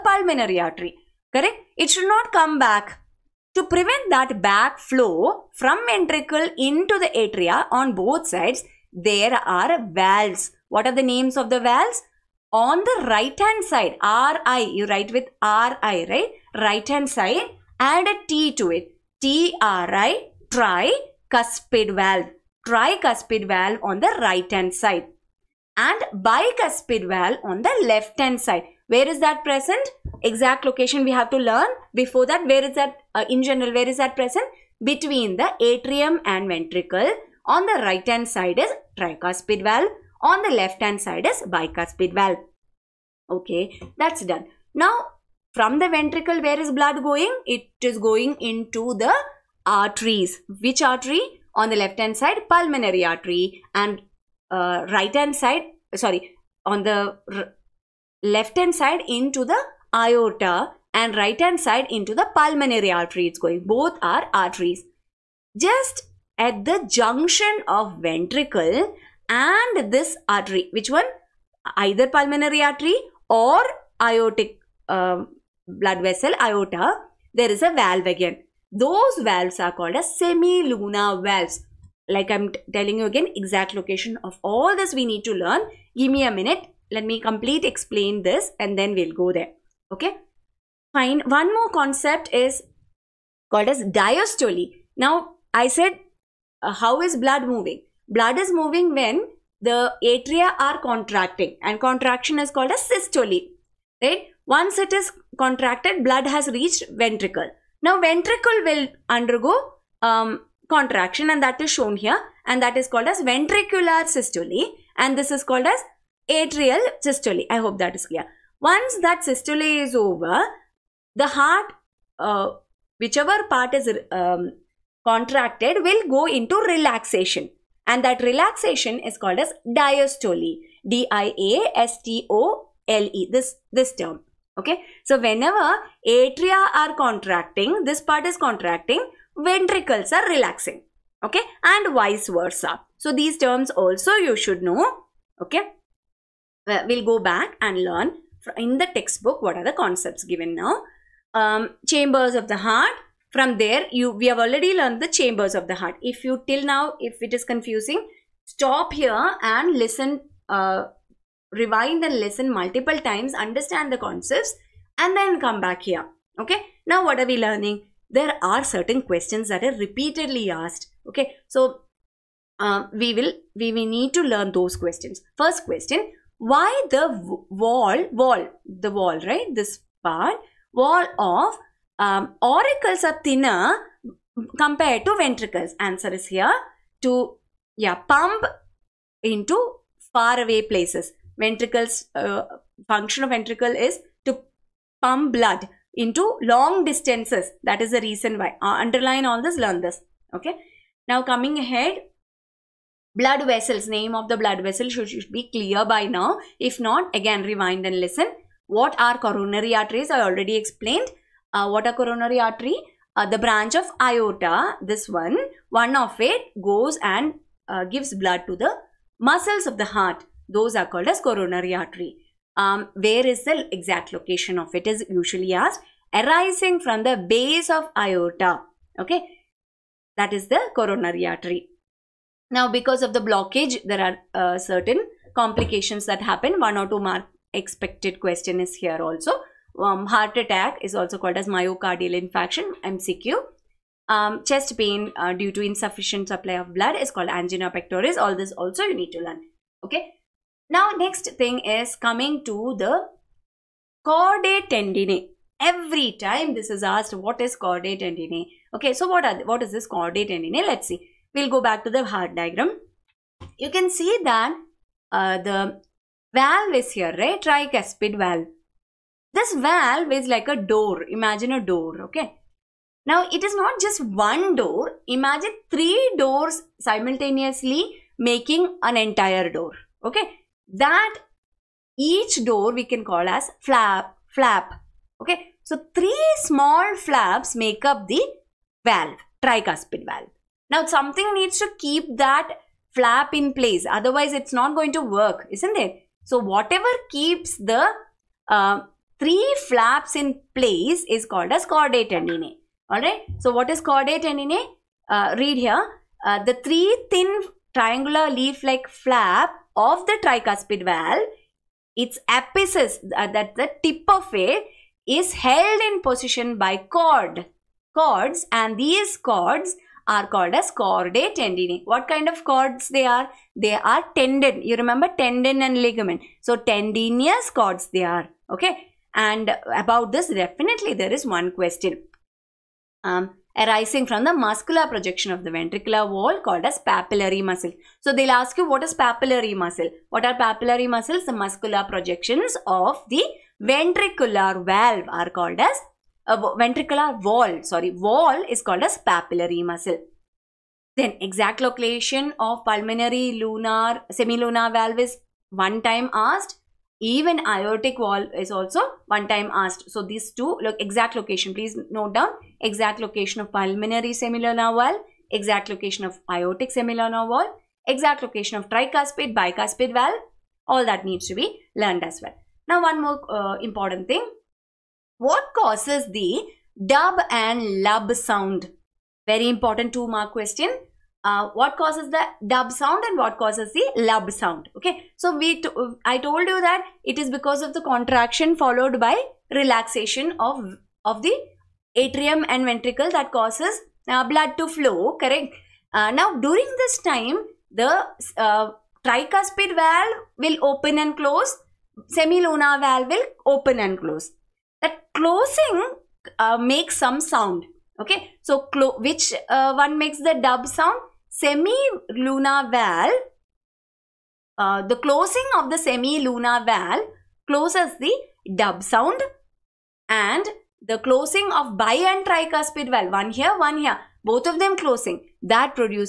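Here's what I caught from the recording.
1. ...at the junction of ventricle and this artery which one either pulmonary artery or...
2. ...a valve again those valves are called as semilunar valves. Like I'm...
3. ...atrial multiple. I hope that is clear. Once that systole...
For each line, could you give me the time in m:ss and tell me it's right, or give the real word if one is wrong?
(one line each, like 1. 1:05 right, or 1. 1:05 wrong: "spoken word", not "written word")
1. 1:06 right
2. 1:17 right
3. 1:56 wrong: "systole", not "multiple".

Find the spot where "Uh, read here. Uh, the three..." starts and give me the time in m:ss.
5:05.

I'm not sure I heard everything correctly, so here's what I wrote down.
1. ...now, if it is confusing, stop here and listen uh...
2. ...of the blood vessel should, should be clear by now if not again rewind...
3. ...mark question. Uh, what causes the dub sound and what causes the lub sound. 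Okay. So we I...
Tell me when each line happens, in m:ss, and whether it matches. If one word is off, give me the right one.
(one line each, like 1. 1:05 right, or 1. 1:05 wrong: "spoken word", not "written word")
1. 2:36 right
2. 3:24 right
3. 6:20 right.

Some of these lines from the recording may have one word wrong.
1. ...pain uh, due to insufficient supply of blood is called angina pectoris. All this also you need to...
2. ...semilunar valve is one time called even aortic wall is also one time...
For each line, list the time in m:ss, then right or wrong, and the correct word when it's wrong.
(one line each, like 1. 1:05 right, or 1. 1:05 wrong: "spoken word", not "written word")
1. 4:04 right
2. 5:54 wrong: "asked", not "called".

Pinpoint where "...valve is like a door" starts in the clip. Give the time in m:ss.
4:29.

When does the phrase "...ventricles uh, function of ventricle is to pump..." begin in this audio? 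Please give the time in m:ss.
3:11.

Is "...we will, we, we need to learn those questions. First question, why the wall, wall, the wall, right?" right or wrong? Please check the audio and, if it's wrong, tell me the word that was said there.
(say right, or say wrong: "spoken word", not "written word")
right.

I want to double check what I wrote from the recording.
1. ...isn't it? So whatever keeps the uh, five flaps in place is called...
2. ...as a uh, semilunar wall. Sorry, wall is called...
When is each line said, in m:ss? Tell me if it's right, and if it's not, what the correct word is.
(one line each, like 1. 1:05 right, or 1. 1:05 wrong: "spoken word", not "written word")
1. 4:55 wrong: "three", not "five"
2. 5:45 wrong: "ventricular", not "semilunar".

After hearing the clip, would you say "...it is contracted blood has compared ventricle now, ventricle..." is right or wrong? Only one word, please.
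wrong.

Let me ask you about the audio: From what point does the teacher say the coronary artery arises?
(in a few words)
base of aorta.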